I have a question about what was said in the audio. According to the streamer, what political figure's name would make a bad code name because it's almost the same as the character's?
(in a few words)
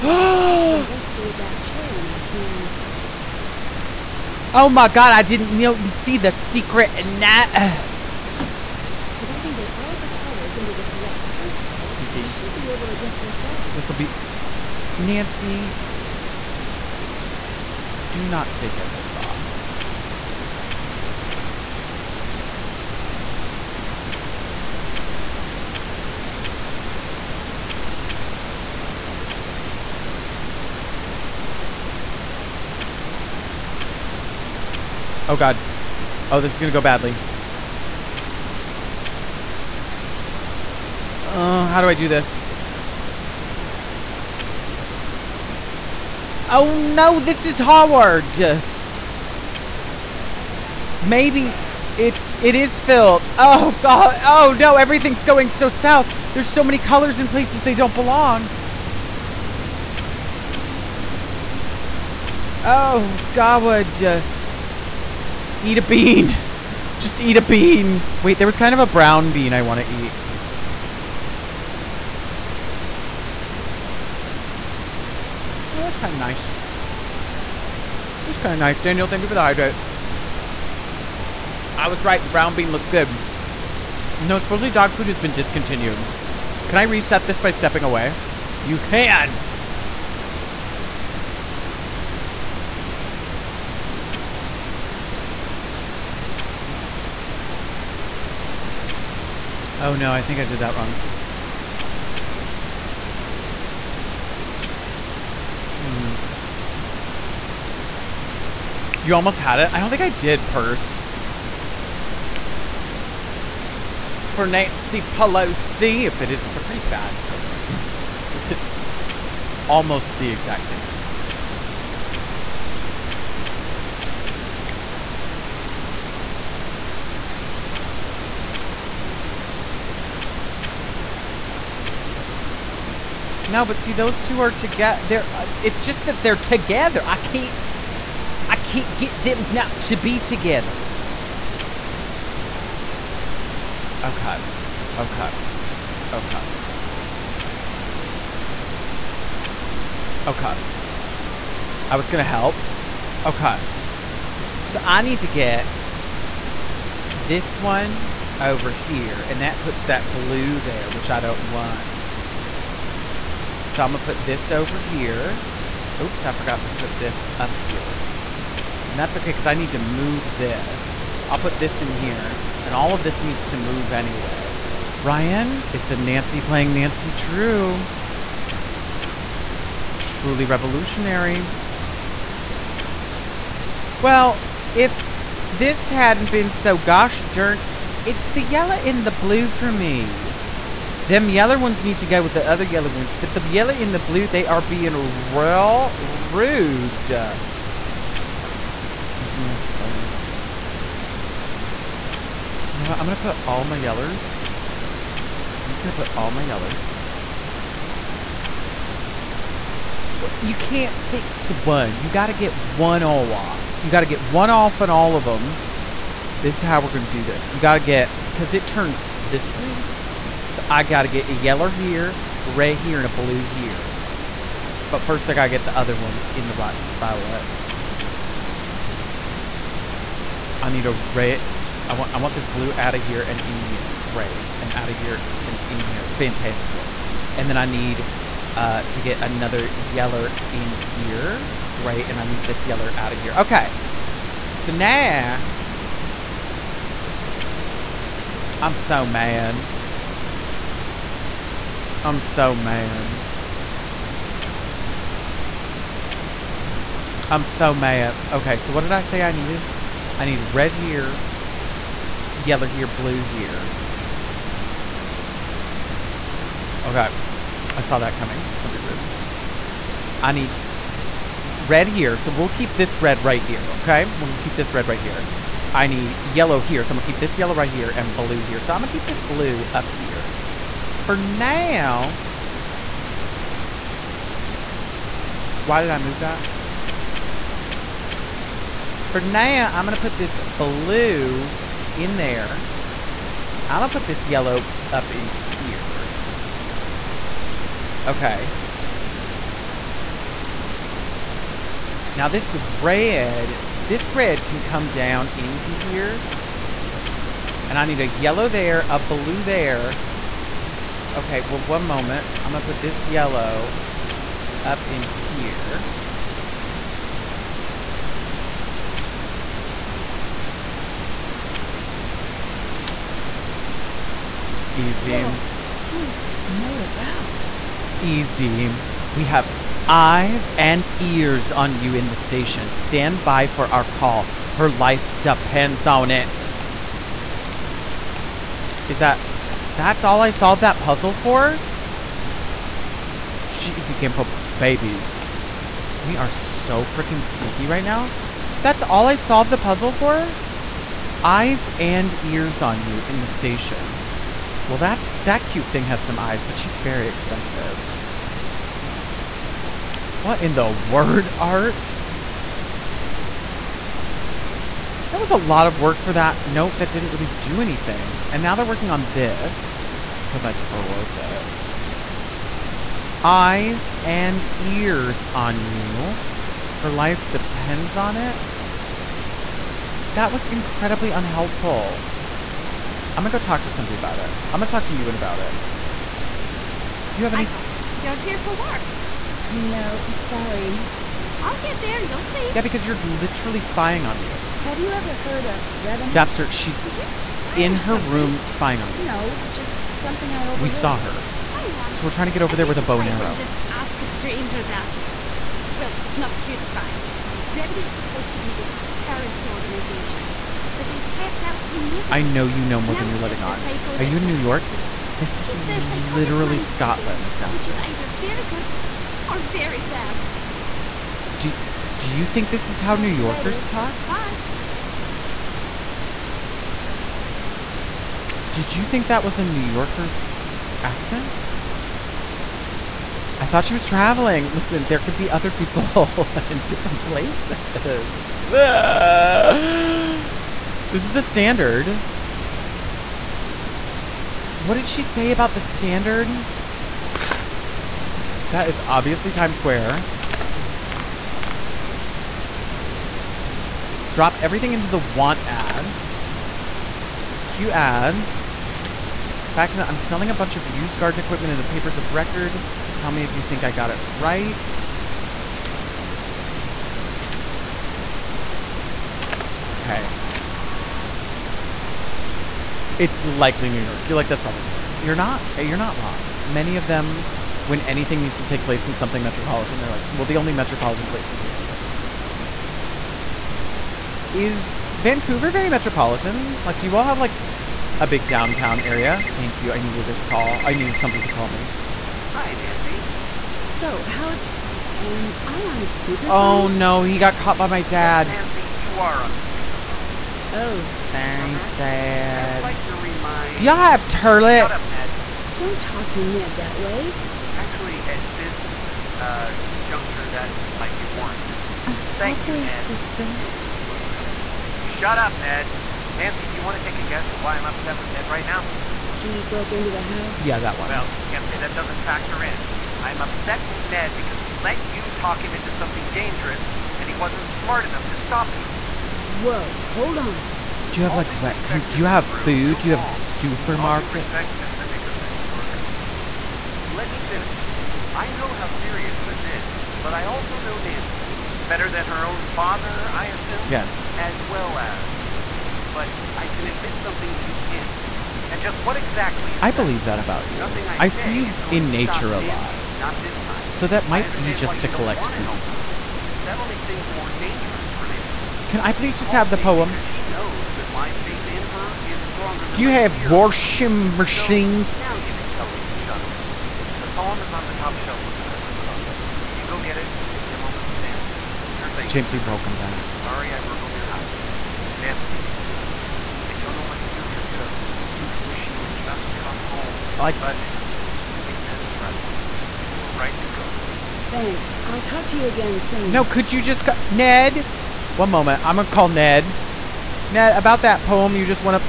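Nancy Pelosi.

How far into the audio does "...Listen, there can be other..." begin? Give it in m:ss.
7:14.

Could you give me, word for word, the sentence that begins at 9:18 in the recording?
Can I please she just have the poem?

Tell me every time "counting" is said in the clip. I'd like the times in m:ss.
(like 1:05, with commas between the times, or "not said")
not said.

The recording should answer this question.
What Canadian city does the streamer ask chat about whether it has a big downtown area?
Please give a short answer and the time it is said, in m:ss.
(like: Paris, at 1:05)
Vancouver, at 8:04.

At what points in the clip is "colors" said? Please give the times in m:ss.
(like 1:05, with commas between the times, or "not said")
0:10, 0:56.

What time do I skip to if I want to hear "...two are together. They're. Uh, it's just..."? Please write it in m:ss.
2:14.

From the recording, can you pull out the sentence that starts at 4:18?
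Okay, so what did I say I needed?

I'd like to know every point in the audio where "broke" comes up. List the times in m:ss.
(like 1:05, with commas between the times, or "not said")
6:10, 8:39.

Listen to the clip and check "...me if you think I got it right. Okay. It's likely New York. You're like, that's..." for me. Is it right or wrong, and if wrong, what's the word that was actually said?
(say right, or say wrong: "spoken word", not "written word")
right.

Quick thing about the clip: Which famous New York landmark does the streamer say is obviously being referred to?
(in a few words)
Times Square.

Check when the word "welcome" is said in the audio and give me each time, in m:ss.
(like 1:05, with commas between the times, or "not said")
8:33, 9:32.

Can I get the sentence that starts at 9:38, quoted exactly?
I wish you would just come home.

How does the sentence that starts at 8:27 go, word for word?
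Actually, at this uh, juncture, that might be warranted.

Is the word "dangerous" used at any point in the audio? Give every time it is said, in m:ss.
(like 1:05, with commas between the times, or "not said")
8:46, 9:17.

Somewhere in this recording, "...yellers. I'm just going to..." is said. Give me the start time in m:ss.
3:23.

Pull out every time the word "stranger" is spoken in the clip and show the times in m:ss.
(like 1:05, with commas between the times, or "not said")
6:44.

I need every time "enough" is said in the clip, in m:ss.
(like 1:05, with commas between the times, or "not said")
8:47.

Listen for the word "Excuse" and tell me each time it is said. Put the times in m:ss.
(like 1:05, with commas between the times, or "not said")
3:18.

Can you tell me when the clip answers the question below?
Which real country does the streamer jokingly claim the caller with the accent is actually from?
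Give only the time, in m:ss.
6:56.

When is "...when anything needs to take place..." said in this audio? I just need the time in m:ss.
7:57.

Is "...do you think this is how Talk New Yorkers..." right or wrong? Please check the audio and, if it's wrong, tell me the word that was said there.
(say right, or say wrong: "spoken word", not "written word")
right.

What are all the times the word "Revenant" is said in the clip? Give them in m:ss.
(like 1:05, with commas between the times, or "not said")
6:35, 6:47.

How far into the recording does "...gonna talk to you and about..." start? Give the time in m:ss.
6:24.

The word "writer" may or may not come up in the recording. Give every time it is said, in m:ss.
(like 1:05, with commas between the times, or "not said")
not said.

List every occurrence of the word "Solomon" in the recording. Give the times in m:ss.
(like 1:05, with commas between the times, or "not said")
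not said.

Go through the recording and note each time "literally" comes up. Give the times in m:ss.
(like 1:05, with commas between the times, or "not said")
6:32, 6:56.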